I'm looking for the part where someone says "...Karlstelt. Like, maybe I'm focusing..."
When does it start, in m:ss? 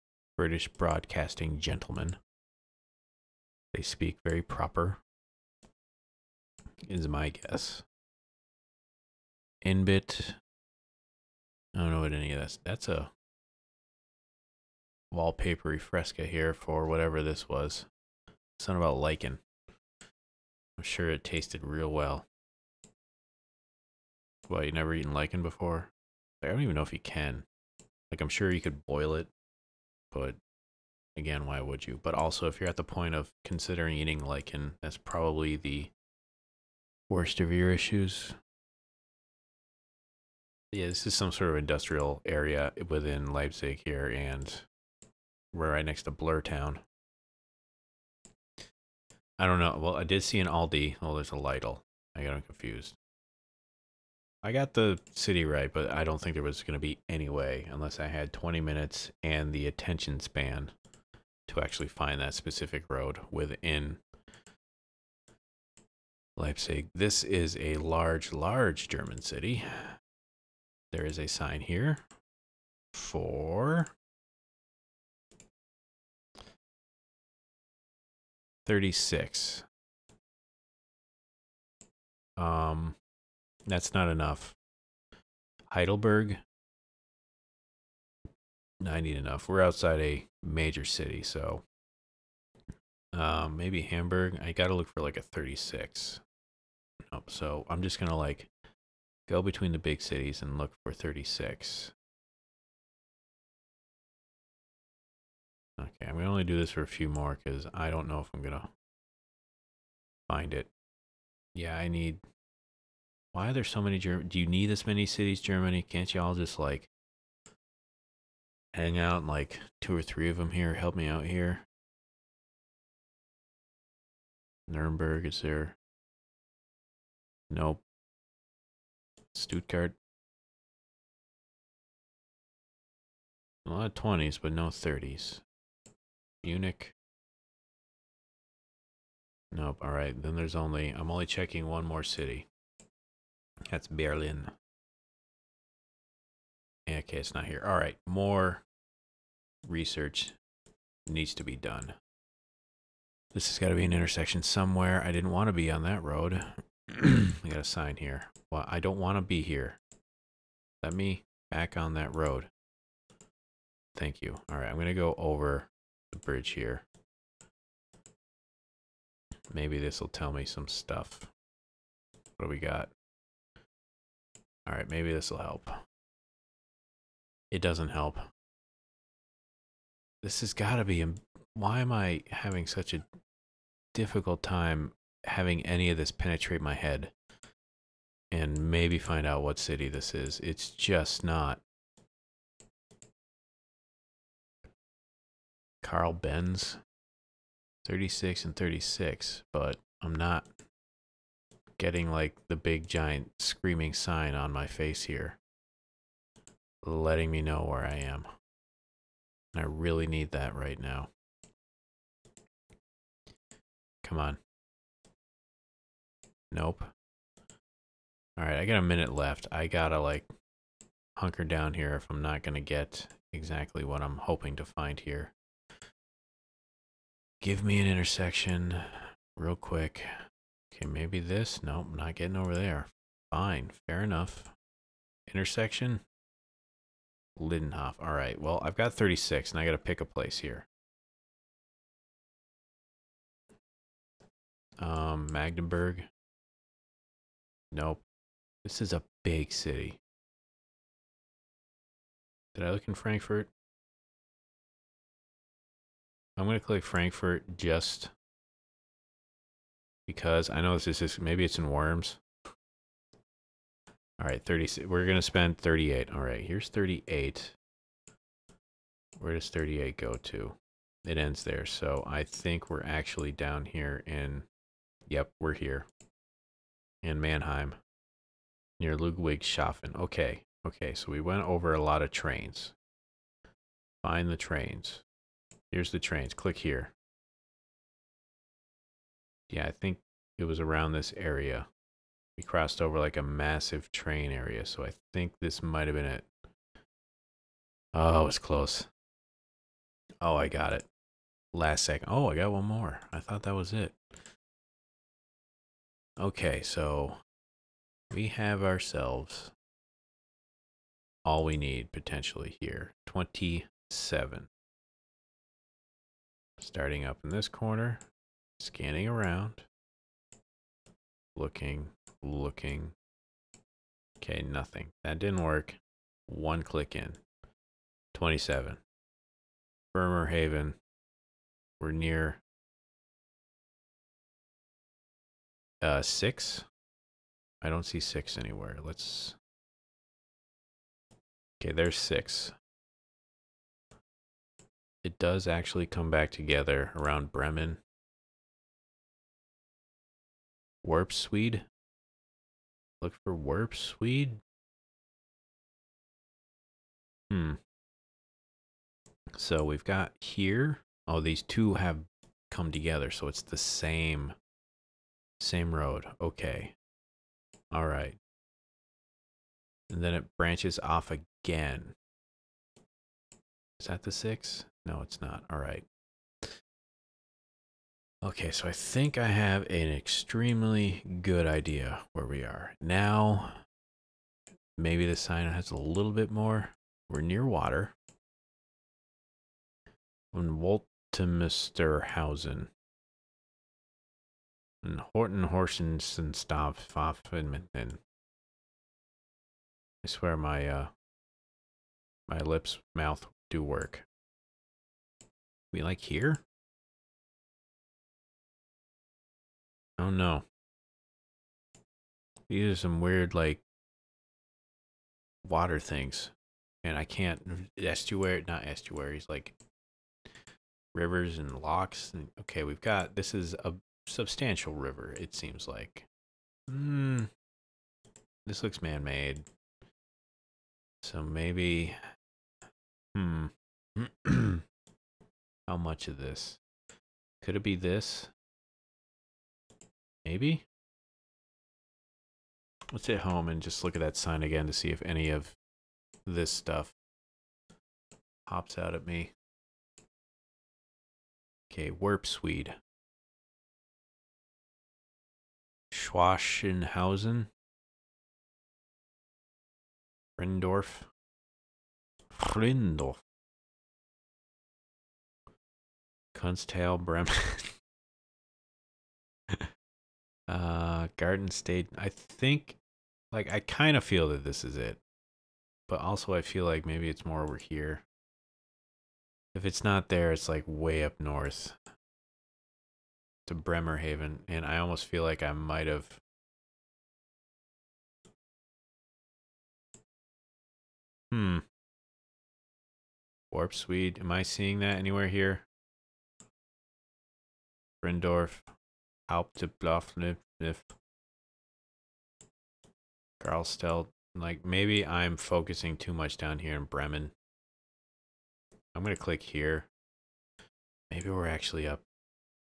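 8:23.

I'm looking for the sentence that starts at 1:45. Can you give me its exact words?
Okay, I'm going to only do this for a few more because I don't know if I'm going to find it.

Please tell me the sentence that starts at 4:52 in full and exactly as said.
We crossed over like a massive train area, so I think this might have been it.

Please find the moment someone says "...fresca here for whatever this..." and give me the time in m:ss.
0:15.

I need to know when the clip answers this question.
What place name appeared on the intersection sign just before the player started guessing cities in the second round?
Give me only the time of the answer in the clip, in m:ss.
3:57.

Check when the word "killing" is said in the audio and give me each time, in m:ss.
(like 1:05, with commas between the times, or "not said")
not said.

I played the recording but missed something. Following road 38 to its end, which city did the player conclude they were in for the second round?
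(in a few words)
Mannheim.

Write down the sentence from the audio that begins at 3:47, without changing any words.
Give me an intersection real quick.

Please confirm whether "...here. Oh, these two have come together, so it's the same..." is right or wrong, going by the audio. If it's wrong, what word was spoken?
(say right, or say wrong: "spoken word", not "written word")
right.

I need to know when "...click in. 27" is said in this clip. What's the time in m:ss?
5:26.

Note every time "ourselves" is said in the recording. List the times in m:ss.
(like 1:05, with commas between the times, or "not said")
5:08.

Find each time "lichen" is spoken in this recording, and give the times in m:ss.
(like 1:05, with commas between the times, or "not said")
0:18, 0:25, 0:34.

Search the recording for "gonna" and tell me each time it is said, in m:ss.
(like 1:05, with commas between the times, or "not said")
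1:37, 3:42.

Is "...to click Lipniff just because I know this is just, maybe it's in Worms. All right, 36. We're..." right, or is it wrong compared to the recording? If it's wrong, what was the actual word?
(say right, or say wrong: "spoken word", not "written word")
wrong: "Frankfurt", not "Lipniff".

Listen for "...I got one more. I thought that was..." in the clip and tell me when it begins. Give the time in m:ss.
5:02.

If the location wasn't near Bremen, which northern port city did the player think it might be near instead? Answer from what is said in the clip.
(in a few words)
Bremerhaven.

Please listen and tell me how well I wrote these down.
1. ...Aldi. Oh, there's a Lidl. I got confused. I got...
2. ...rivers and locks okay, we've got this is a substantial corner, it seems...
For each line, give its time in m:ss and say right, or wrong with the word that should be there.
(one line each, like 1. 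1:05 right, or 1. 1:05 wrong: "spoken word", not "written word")
1. 0:50 right
2. 7:00 wrong: "river", not "corner".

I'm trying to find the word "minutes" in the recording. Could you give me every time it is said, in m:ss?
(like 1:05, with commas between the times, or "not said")
0:58, 3:38.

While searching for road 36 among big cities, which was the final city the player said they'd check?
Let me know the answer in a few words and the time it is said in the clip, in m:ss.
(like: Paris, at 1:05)
Berlin, at 2:23.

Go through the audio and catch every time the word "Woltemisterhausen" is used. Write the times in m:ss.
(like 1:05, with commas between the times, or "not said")
6:30.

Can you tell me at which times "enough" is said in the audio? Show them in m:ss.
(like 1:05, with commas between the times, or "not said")
1:24, 1:29, 3:54.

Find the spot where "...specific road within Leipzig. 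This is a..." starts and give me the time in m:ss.
1:02.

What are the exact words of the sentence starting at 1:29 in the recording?
We're outside a major city, so um, maybe Hamburg.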